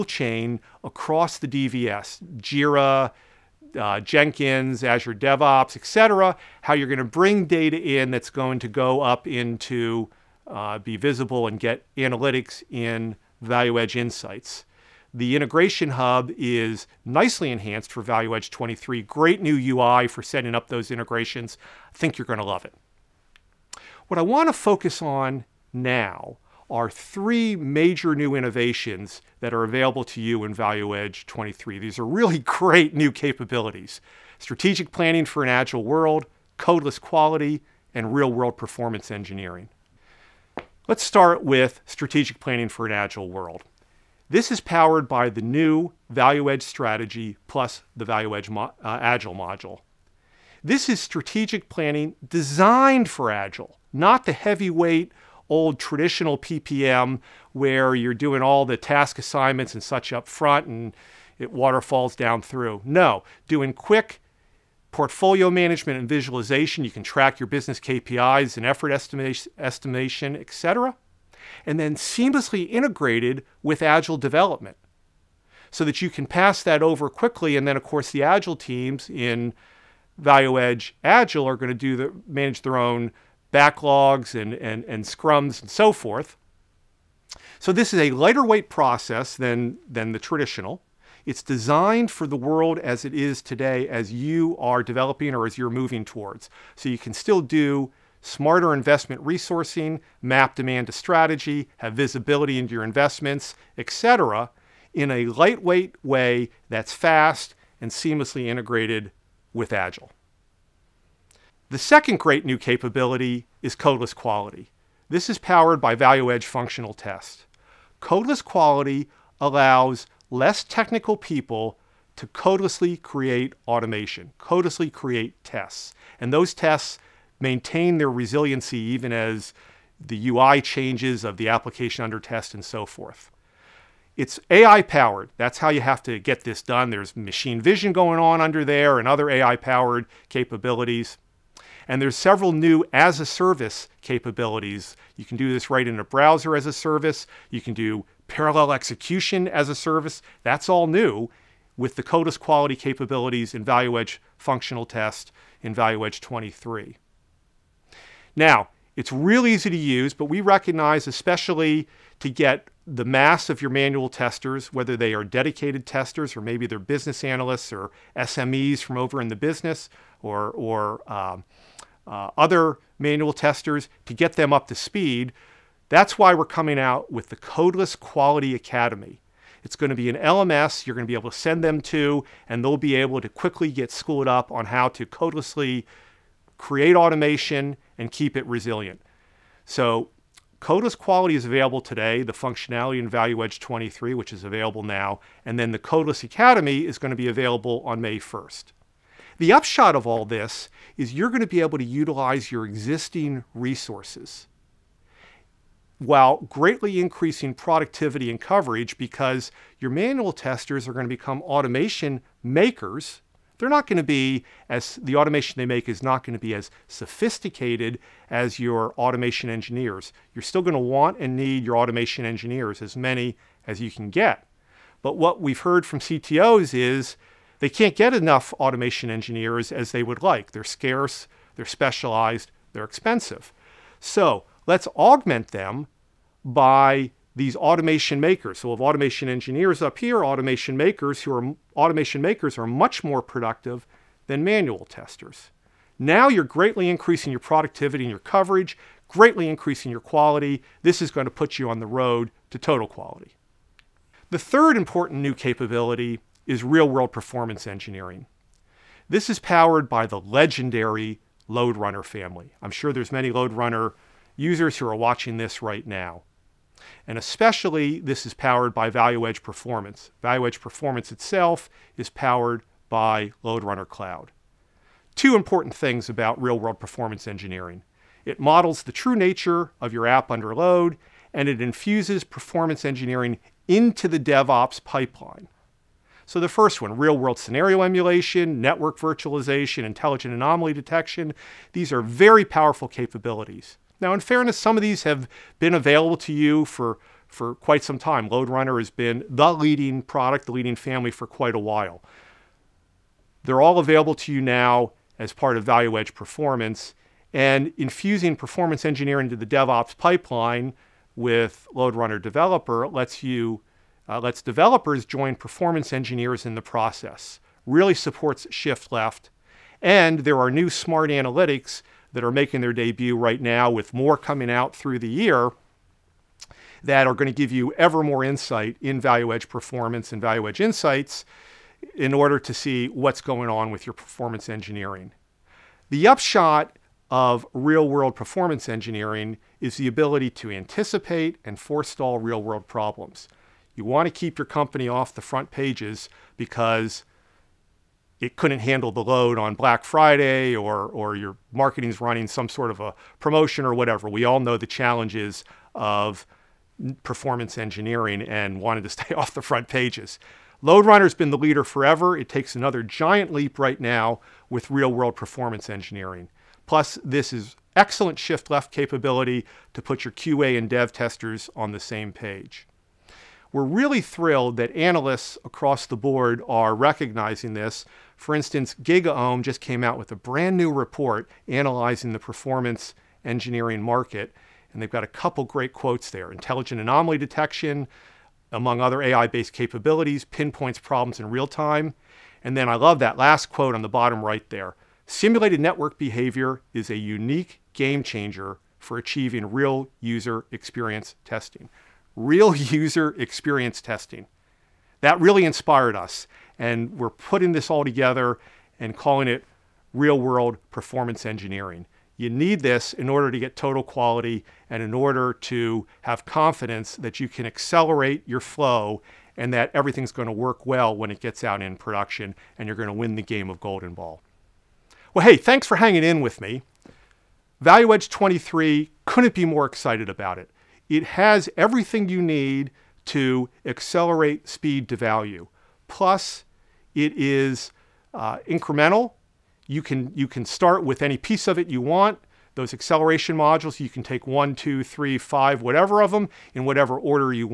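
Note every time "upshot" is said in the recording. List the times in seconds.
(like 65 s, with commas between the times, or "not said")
199 s, 336 s.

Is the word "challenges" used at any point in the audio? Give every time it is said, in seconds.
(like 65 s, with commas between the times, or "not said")
354 s.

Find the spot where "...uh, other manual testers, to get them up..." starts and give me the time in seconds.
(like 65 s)
172 s.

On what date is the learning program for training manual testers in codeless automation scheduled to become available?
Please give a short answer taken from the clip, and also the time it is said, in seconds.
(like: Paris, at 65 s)
May 1st, at 197 s.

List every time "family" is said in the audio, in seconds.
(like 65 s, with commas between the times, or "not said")
262 s, 300 s.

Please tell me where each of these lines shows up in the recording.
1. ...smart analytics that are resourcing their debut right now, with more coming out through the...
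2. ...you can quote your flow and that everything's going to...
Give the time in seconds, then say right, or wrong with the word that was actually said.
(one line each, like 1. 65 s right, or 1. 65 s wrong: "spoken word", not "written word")
1. 320 s wrong: "making", not "resourcing"
2. 417 s wrong: "accelerate", not "quote".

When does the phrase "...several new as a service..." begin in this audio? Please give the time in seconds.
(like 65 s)
142 s.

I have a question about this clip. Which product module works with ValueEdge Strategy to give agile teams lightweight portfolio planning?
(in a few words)
ValueEdge Agile.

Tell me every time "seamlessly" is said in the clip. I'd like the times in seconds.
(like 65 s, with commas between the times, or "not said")
71 s, 107 s.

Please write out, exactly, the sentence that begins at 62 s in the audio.
No, doing quick portfolio management and visualization.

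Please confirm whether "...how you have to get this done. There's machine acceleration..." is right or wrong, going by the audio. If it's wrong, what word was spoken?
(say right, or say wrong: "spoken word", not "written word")
wrong: "vision", not "acceleration".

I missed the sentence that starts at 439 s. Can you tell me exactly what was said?
You can, you can start with any piece of it you want.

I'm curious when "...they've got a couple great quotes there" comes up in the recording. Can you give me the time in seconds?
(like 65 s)
384 s.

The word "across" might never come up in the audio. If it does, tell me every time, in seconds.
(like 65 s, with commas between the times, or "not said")
0 s, 375 s.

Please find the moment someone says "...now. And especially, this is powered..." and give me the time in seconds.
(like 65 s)
265 s.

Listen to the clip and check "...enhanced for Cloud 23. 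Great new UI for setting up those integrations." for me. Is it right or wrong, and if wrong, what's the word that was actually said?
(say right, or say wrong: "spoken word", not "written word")
wrong: "ValueEdge", not "Cloud".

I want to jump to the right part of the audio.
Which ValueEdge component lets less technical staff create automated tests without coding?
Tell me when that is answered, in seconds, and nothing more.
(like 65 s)
115 s.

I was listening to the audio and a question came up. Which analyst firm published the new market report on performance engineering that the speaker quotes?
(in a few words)
GigaOM.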